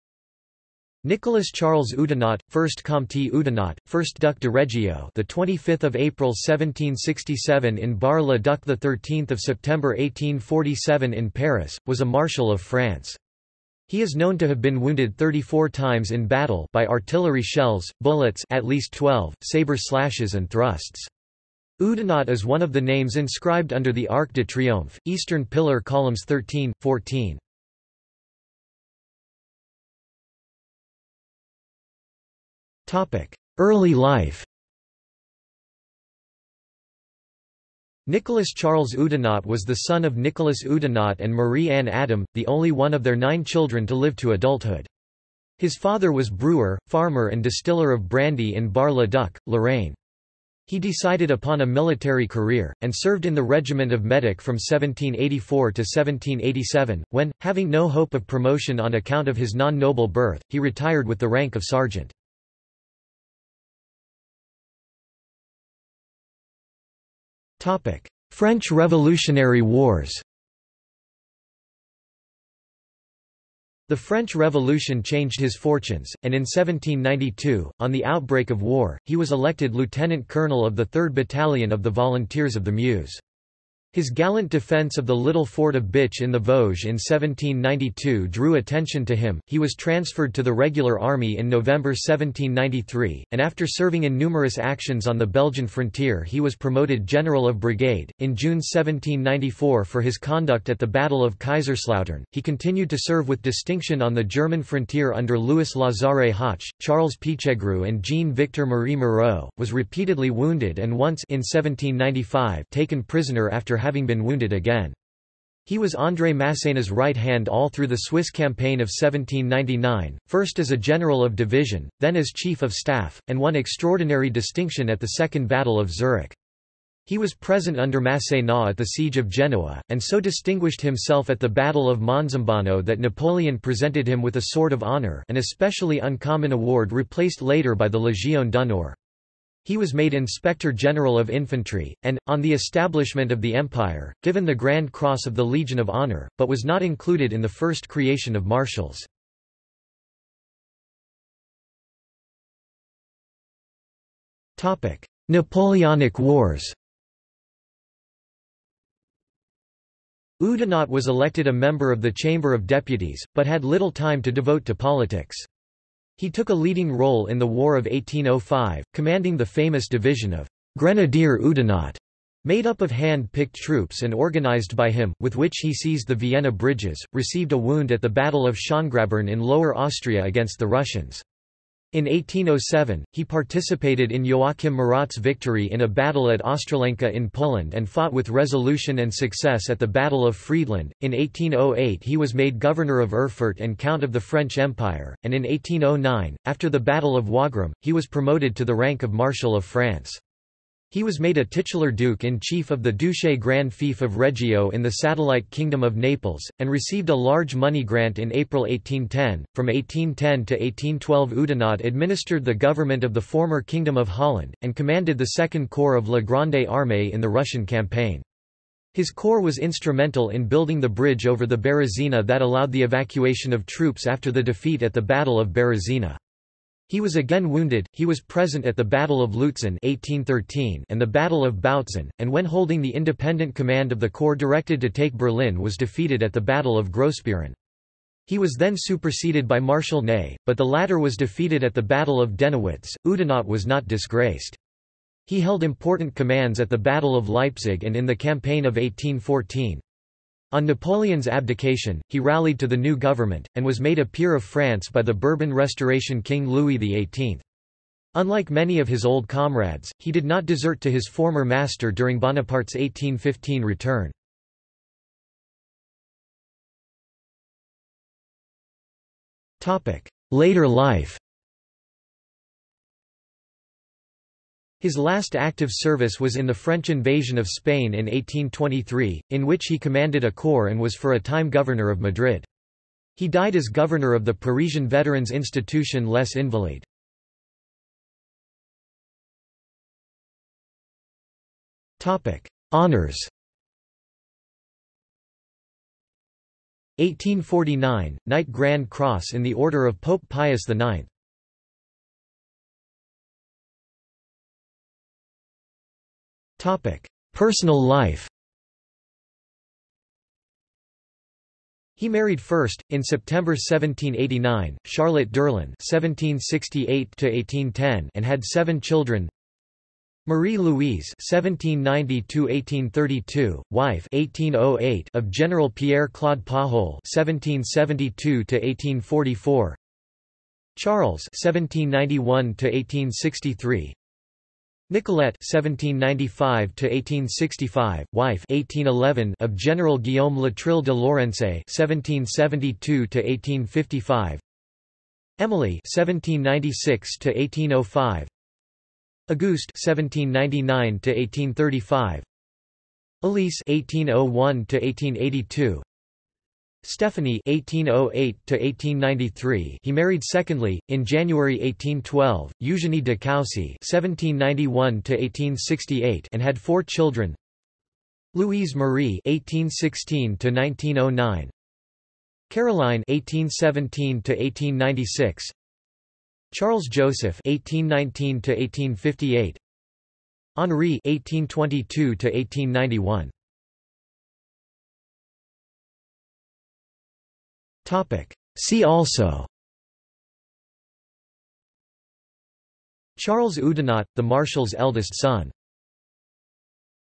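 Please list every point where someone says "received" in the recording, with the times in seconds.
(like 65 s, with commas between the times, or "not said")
177 s, 206 s.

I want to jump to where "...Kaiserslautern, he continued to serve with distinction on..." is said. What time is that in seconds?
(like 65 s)
101 s.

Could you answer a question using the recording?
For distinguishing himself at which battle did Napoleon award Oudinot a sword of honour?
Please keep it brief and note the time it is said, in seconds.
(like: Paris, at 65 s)
Battle of Monzambano, at 131 s.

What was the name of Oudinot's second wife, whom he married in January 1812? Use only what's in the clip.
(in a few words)
Eugenie de Coucy.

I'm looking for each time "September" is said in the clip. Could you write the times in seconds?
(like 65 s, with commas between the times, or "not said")
9 s, 313 s.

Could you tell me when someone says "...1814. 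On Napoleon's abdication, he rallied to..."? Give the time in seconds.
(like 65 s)
248 s.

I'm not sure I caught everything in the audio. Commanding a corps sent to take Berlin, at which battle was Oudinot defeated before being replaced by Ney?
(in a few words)
Battle of Grossbeeren.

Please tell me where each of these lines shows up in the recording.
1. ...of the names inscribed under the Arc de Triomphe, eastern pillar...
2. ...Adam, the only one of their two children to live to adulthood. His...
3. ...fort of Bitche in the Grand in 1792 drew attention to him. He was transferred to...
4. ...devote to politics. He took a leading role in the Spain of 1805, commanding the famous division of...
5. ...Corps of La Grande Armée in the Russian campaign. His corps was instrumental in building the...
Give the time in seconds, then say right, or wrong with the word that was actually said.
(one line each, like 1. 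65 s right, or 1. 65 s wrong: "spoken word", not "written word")
1. 22 s right
2. 41 s wrong: "nine", not "two"
3. 85 s wrong: "Vosges", not "Grand"
4. 164 s wrong: "War", not "Spain"
5. 215 s right.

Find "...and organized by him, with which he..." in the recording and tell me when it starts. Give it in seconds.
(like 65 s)
174 s.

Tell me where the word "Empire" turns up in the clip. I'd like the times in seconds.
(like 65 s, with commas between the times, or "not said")
143 s, 194 s.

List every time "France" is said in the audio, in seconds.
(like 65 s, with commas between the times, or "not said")
12 s, 199 s, 254 s.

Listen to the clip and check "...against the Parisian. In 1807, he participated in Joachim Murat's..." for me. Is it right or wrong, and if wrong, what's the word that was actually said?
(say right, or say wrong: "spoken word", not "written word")
wrong: "Russians", not "Parisian".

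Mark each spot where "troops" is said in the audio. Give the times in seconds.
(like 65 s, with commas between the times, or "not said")
173 s, 223 s.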